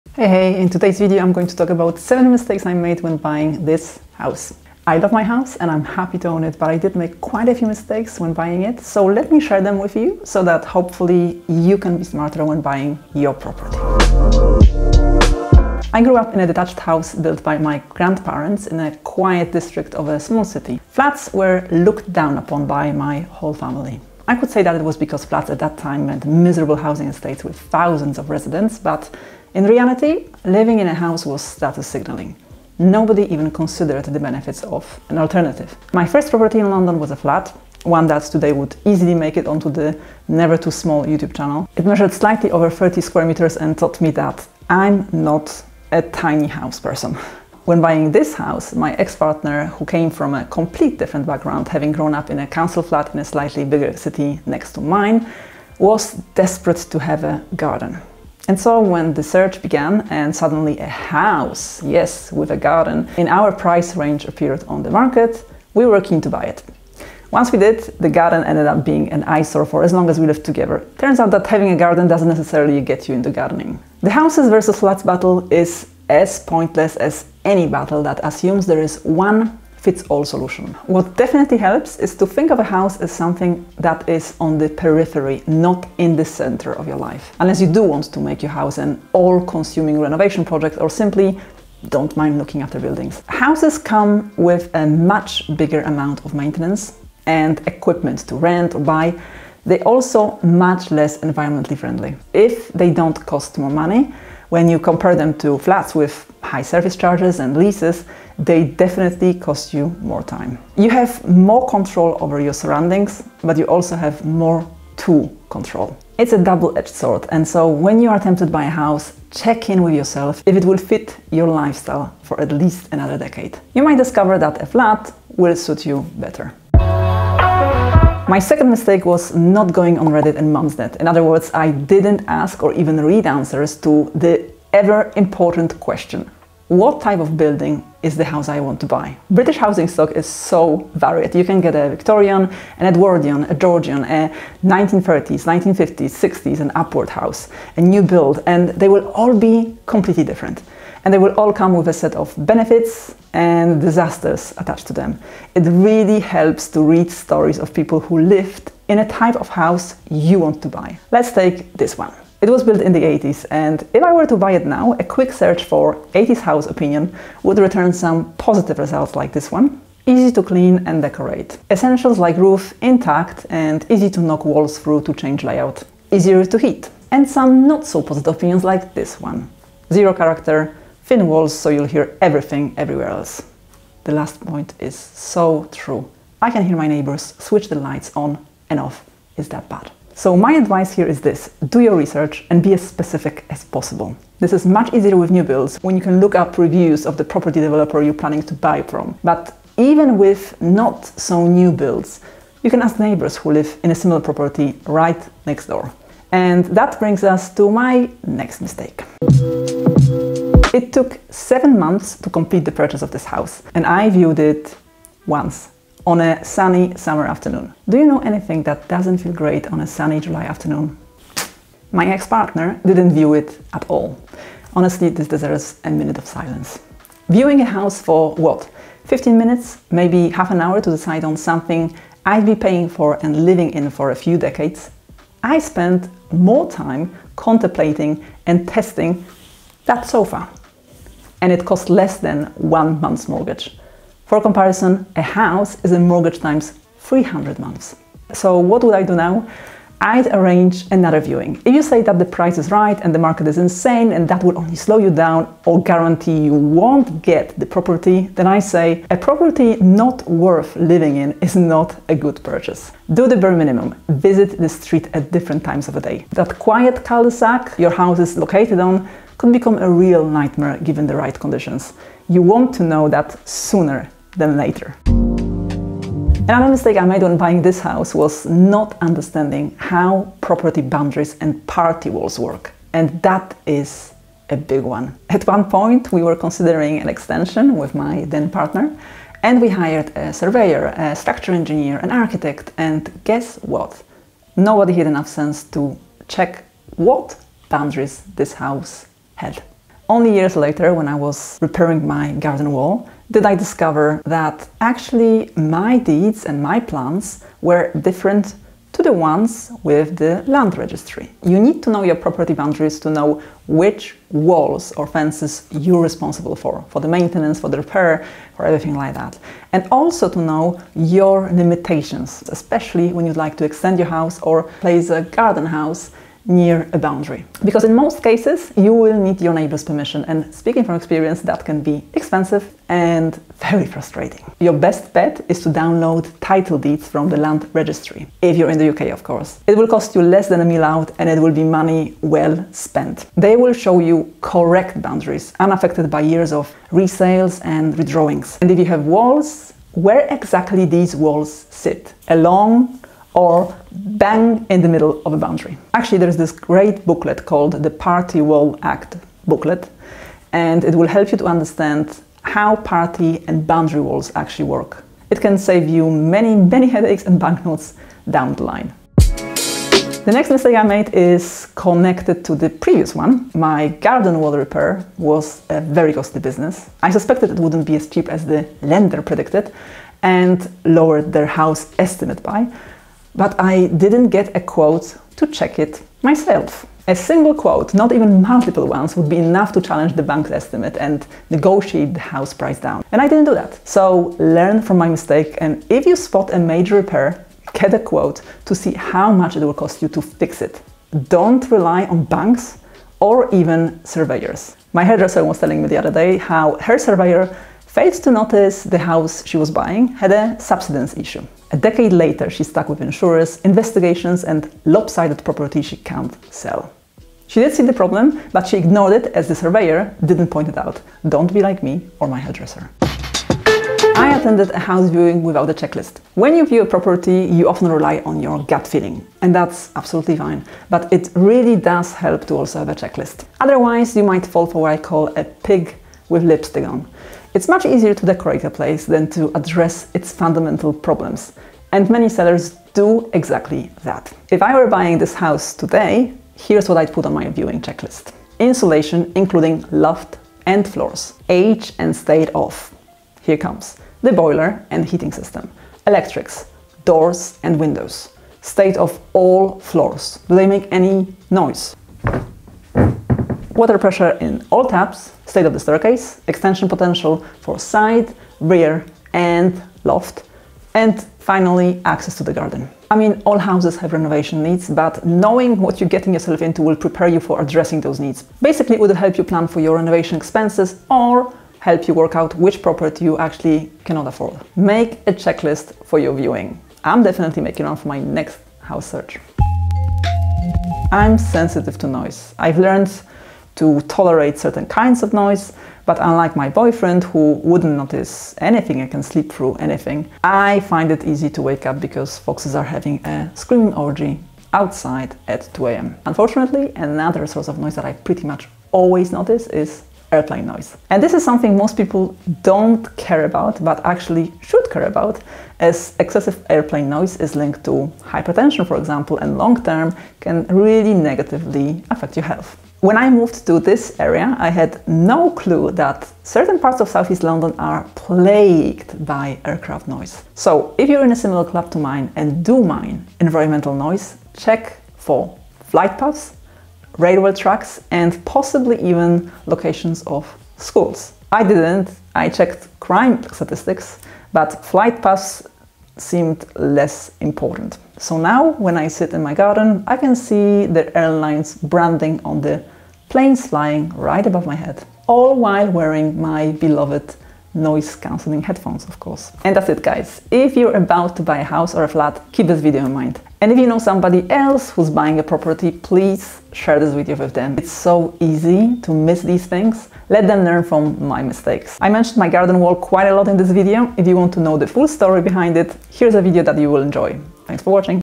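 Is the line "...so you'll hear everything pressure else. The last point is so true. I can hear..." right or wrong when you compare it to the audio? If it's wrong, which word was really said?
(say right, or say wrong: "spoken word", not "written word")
wrong: "everywhere", not "pressure".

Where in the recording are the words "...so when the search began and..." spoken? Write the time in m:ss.
0:58.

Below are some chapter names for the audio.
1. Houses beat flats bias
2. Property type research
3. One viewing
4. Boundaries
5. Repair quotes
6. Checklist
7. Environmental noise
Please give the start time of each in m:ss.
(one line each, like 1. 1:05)
1. 0:14
2. 2:06
3. 3:29
4. 4:35
5. 6:09
6. 7:03
7. 8:09.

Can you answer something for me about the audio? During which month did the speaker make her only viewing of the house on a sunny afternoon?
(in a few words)
July.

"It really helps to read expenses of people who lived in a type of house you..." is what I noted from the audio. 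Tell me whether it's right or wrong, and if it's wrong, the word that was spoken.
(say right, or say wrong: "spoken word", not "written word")
wrong: "stories", not "expenses".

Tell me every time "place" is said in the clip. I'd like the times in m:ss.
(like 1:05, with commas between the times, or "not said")
5:24, 7:18.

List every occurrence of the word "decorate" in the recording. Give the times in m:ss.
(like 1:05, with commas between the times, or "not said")
2:51, 7:18.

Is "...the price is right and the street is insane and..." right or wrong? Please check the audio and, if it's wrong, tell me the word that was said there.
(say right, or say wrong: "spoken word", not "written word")
wrong: "market", not "street".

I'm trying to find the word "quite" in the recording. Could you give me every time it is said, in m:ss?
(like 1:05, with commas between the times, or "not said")
0:07, 9:32.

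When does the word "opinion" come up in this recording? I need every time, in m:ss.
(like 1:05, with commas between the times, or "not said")
2:46, 2:58.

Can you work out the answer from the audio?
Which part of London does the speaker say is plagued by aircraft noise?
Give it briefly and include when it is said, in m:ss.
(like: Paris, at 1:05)
Southeast London, at 8:47.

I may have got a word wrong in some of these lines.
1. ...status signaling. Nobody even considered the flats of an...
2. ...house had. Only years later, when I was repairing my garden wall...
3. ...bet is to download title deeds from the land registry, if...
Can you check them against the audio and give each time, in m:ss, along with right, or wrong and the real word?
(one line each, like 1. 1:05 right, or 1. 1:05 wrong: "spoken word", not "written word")
1. 0:31 wrong: "benefits", not "flats"
2. 4:58 right
3. 5:35 right.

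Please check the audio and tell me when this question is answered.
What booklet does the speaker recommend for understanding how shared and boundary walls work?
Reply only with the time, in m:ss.
5:57.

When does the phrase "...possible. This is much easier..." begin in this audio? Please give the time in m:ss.
3:13.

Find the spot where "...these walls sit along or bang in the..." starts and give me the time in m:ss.
5:50.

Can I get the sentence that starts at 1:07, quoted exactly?
Once we did, the garden ended up being an eyesore for as long as we lived together.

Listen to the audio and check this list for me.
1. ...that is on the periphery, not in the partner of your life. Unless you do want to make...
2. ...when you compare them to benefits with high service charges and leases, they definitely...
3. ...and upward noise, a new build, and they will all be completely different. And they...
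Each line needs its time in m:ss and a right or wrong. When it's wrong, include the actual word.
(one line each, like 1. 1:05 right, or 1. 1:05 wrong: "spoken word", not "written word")
1. 1:23 wrong: "center", not "partner"
2. 1:44 wrong: "flats", not "benefits"
3. 2:26 wrong: "house", not "noise".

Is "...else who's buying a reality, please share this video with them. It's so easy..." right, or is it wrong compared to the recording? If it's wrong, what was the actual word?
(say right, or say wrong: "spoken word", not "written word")
wrong: "property", not "reality".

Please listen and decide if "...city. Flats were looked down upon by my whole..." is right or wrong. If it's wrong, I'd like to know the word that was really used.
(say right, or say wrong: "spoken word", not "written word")
right.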